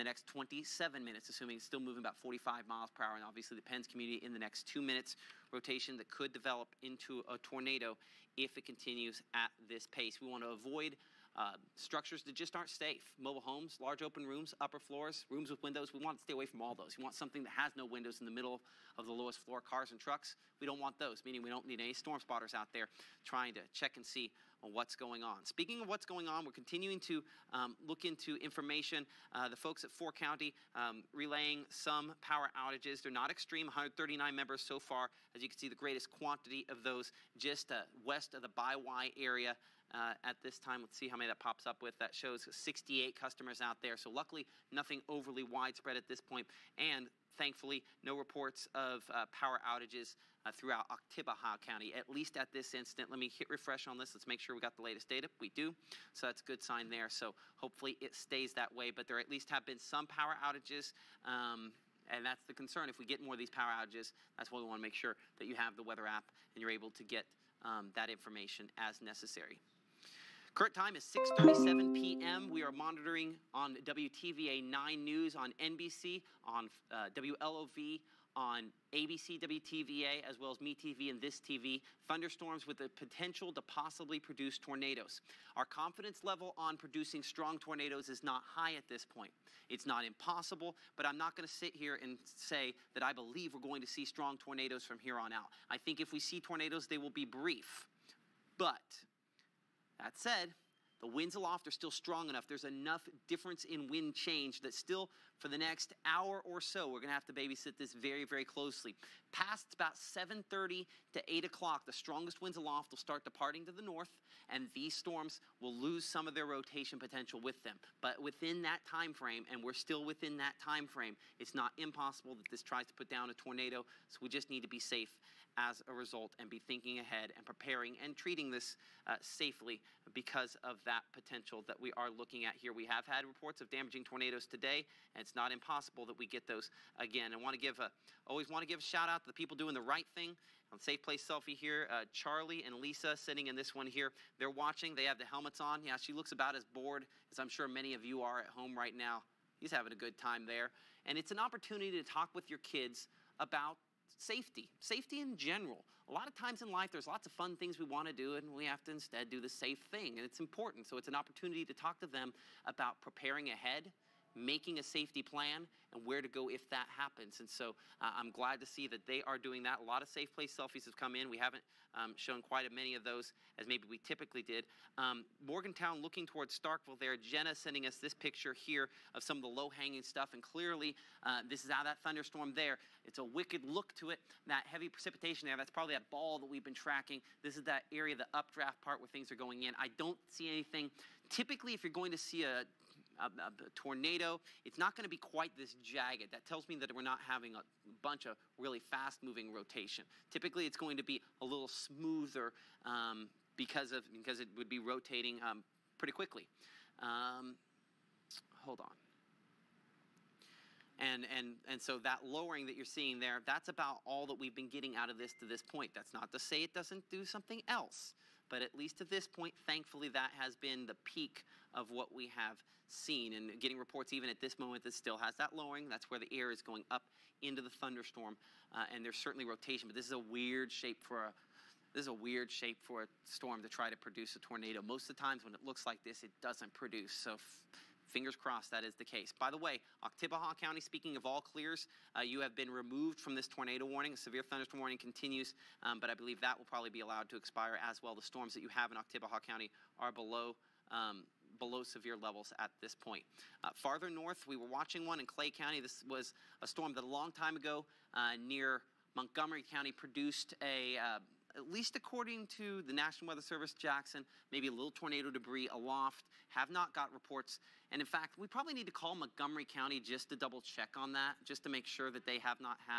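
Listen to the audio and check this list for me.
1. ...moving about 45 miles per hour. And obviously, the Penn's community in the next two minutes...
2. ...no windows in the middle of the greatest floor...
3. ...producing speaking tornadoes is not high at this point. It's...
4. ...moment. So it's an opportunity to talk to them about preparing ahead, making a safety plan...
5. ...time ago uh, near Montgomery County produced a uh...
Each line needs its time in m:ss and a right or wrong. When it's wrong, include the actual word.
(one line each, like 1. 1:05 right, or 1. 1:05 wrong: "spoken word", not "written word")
1. 0:01 right
2. 0:17 wrong: "lowest", not "greatest"
3. 1:26 wrong: "strong", not "speaking"
4. 2:40 wrong: "important", not "moment"
5. 4:17 right.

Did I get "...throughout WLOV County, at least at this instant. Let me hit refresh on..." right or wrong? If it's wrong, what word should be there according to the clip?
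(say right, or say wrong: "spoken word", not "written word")
wrong: "Oktibbeha", not "WLOV".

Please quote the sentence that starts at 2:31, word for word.
And it's an opportunity to talk with your kids about safety, safety in general.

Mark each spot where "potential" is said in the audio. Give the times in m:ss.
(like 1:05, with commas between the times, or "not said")
1:22, 1:56, 2:11.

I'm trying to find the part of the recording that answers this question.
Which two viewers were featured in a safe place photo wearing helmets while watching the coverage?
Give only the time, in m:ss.
2:22.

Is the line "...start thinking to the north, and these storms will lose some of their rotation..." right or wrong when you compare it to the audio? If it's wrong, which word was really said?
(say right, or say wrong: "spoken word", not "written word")
wrong: "departing", not "thinking".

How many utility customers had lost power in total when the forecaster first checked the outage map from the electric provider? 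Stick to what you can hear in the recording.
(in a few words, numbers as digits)
139.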